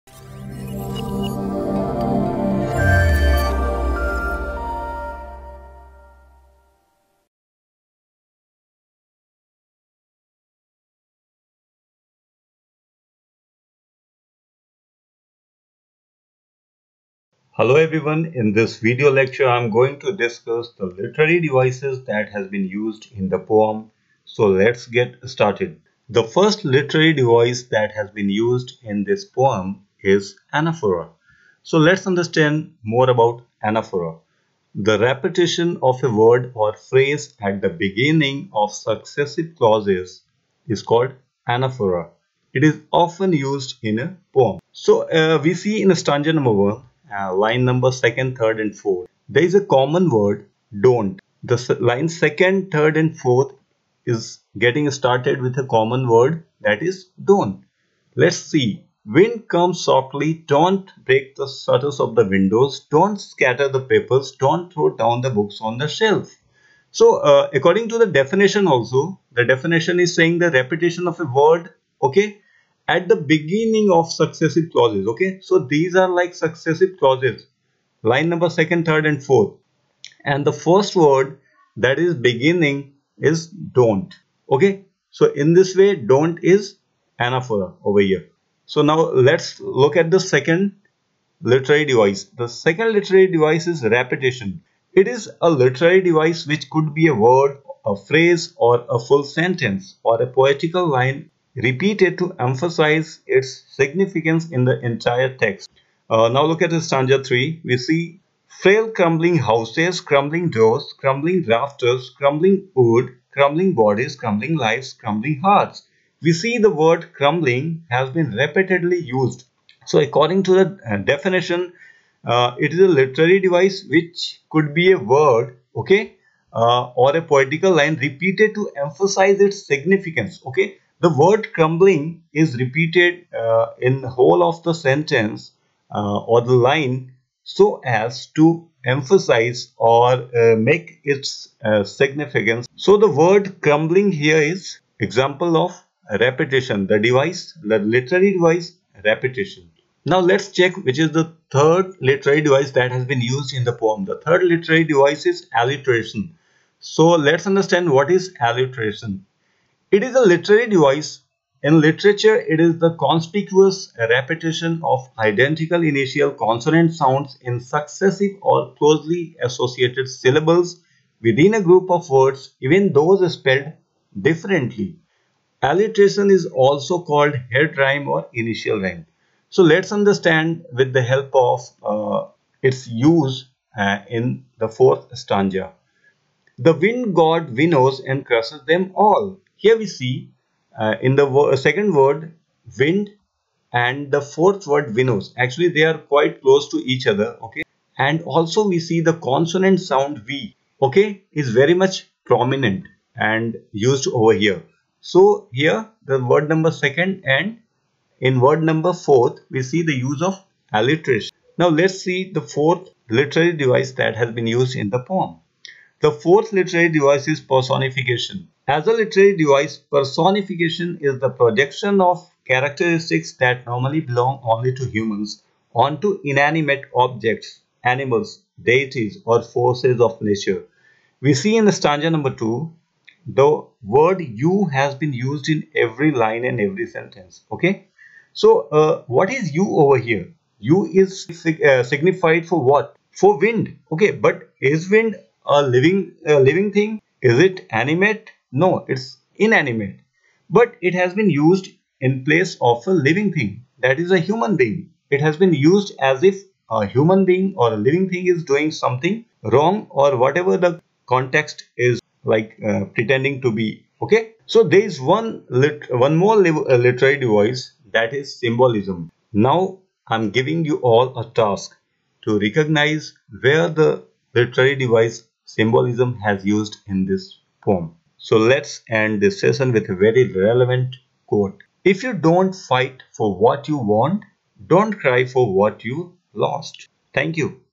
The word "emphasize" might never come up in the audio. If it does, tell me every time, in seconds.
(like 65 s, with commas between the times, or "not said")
102 s, 128 s, 138 s.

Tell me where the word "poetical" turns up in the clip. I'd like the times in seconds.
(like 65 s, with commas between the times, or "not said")
100 s, 127 s.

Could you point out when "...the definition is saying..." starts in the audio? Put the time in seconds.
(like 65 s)
69 s.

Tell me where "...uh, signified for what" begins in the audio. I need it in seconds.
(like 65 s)
241 s.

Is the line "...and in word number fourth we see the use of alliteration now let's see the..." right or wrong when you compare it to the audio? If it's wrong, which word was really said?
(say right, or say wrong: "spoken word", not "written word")
right.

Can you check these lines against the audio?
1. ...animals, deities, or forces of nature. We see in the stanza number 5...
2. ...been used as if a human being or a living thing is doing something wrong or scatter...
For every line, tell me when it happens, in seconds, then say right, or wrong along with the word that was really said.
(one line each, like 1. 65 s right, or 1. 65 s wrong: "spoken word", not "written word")
1. 227 s wrong: "2", not "5"
2. 255 s wrong: "whatever", not "scatter".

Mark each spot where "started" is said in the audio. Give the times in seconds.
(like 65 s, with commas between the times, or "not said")
25 s, 54 s.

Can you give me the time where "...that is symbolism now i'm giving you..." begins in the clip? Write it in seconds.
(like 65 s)
267 s.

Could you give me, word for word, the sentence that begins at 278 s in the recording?
So let's end this session with a very relevant quote.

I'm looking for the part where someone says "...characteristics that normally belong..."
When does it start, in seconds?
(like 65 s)
222 s.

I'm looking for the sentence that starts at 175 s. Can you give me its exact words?
Alliteration is also called head rhyme or initial rhyme.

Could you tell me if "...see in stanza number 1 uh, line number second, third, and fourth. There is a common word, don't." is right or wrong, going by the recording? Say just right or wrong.
right.